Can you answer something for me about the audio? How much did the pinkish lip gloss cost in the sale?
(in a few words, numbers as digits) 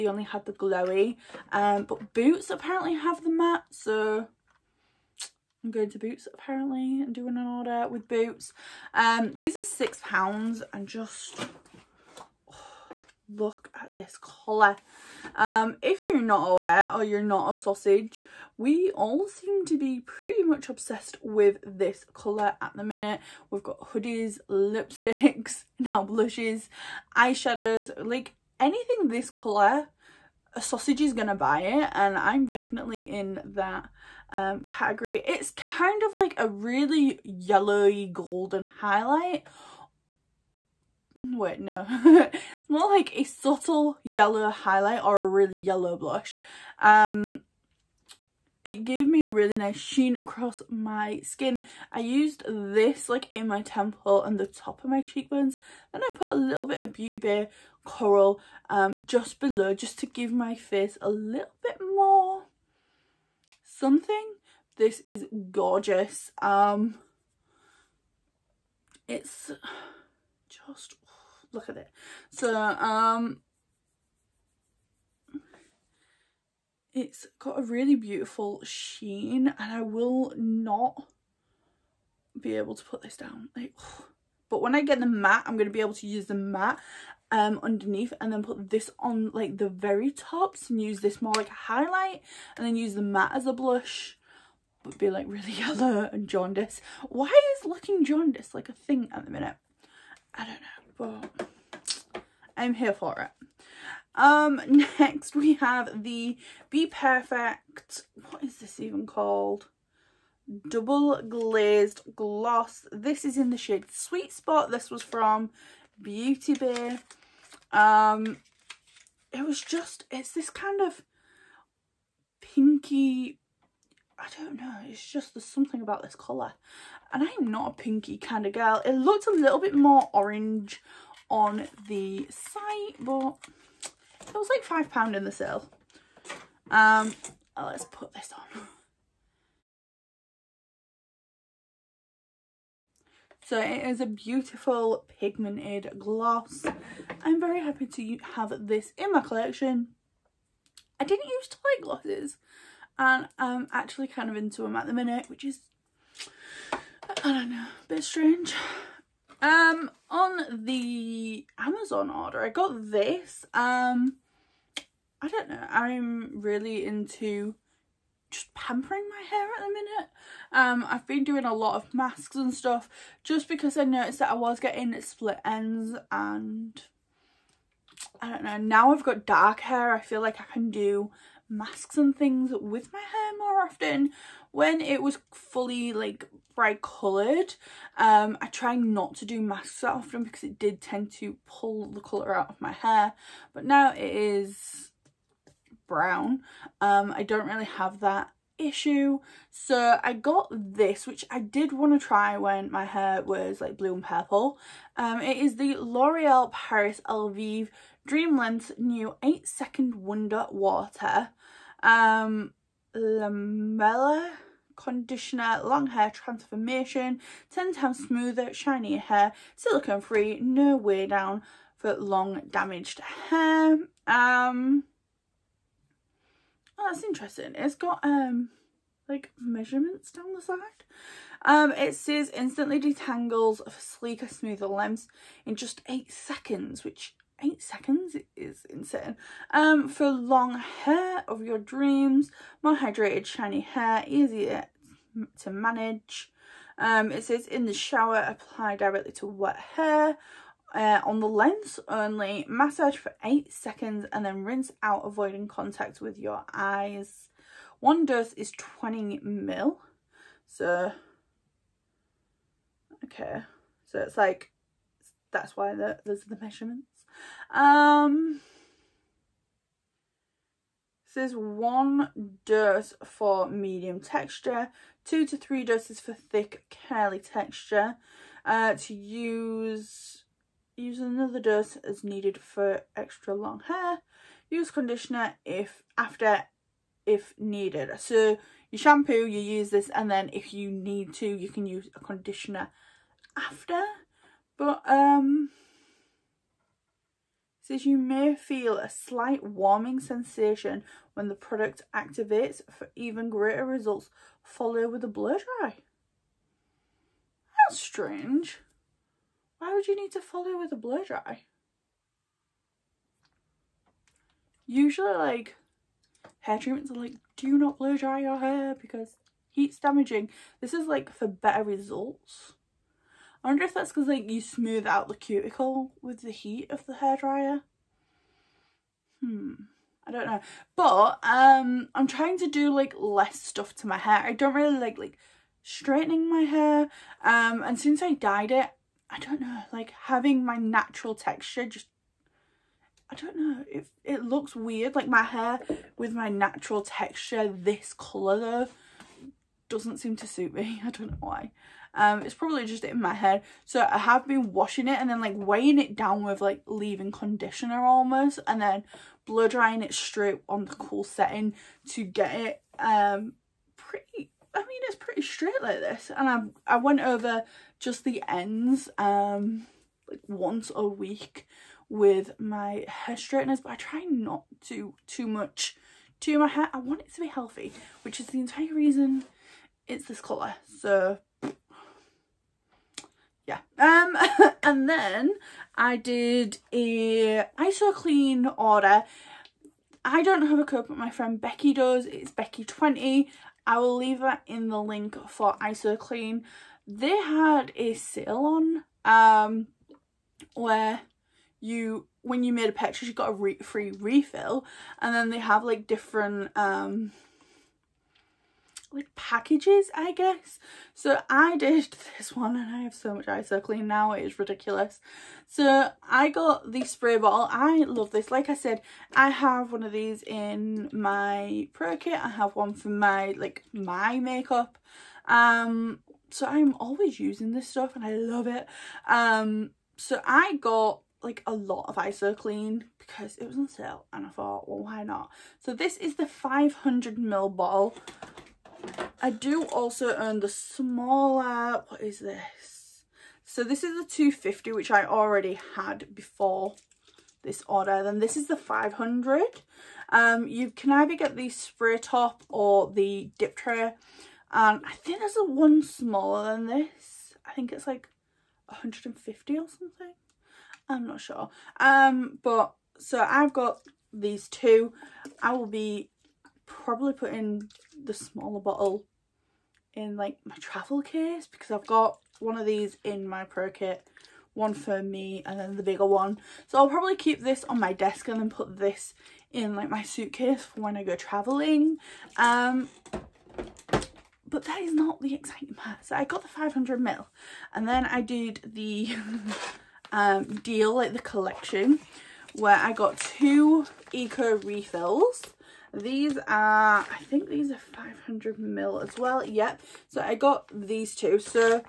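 £5.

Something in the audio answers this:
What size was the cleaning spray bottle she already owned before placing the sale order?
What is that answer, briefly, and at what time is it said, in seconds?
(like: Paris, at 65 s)
250 ml, at 444 s.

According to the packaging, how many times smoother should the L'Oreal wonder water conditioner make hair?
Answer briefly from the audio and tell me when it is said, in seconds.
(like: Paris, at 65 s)
10 times, at 217 s.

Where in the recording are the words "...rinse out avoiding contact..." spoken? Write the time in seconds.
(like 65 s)
254 s.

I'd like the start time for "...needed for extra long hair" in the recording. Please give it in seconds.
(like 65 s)
282 s.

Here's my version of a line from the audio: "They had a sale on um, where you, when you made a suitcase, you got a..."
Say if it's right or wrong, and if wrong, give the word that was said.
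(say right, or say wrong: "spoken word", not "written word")
wrong: "purchase", not "suitcase".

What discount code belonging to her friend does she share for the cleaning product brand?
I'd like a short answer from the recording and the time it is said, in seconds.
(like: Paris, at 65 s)
Becky20, at 392 s.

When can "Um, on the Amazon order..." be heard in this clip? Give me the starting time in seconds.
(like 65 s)
159 s.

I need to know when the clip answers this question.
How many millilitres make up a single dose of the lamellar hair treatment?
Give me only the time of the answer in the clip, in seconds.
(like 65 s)
258 s.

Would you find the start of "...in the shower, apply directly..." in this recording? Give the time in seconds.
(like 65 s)
247 s.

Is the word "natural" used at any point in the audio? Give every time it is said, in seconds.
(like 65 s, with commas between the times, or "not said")
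340 s, 346 s.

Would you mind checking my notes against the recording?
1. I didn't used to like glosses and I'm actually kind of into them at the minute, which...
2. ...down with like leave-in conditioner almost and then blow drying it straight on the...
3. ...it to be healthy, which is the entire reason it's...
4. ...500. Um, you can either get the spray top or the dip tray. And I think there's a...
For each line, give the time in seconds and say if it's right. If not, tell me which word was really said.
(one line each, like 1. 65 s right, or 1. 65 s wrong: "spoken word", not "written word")
1. 151 s right
2. 355 s right
3. 377 s right
4. 448 s right.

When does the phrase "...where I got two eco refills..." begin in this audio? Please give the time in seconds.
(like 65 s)
492 s.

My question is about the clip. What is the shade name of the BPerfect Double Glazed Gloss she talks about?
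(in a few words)
Sweet Spot.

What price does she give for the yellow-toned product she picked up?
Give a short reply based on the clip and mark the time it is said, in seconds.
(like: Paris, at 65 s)
6 pounds, at 9 s.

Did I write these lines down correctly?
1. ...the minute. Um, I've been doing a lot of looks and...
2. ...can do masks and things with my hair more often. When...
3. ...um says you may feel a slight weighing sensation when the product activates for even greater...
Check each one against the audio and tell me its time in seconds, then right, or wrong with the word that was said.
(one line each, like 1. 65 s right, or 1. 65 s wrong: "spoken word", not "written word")
1. 169 s wrong: "masks", not "looks"
2. 180 s right
3. 294 s wrong: "warming", not "weighing".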